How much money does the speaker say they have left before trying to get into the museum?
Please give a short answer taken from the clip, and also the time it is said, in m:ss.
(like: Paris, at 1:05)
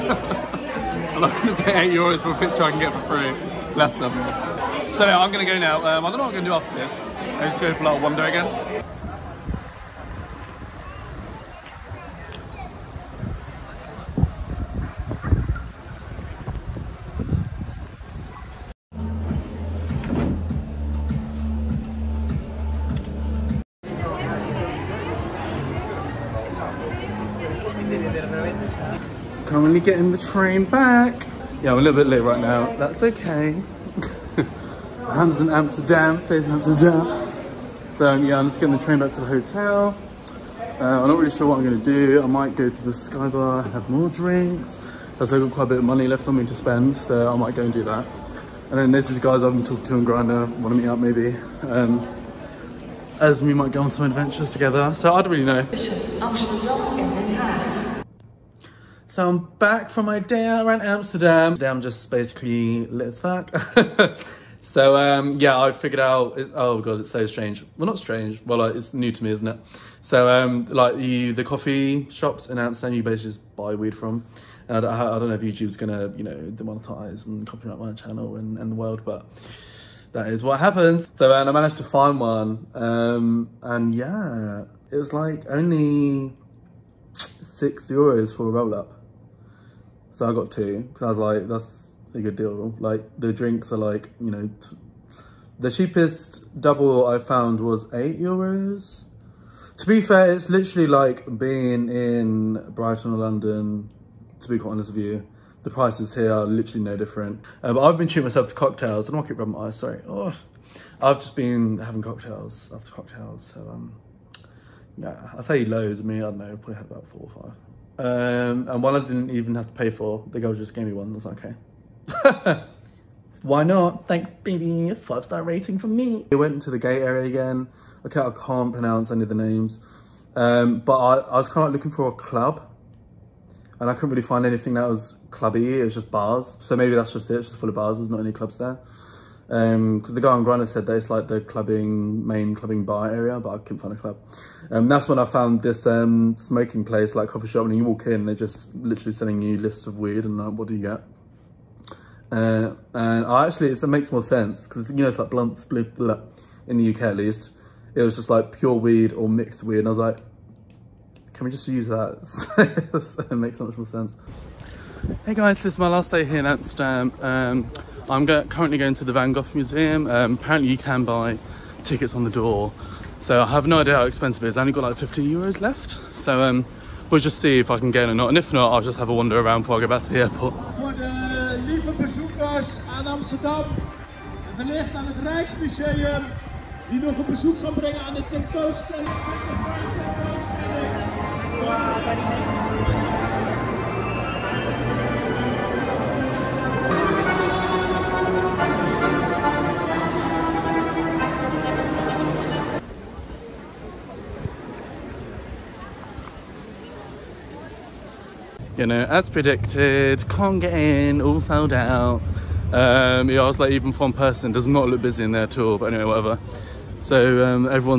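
50 euros, at 2:54.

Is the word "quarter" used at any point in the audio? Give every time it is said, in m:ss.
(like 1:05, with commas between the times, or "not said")
not said.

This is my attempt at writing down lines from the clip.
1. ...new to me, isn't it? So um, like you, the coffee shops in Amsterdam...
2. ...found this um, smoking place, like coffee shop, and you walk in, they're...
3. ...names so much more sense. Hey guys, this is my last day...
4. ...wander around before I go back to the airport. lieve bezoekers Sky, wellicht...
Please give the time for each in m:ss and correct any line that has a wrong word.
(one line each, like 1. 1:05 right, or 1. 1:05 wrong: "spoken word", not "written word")
1. 1:08 right
2. 2:25 right
3. 2:43 wrong: "makes", not "names"
4. 2:59 wrong: "Amsterdam", not "Sky".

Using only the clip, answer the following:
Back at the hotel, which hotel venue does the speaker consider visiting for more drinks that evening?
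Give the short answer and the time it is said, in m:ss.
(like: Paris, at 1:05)
Sky Bar, at 0:42.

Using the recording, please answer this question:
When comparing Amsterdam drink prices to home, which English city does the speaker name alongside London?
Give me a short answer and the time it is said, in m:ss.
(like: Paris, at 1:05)
Brighton, at 1:42.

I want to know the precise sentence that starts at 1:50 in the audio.
Oh, I've just been having cocktails after cocktails.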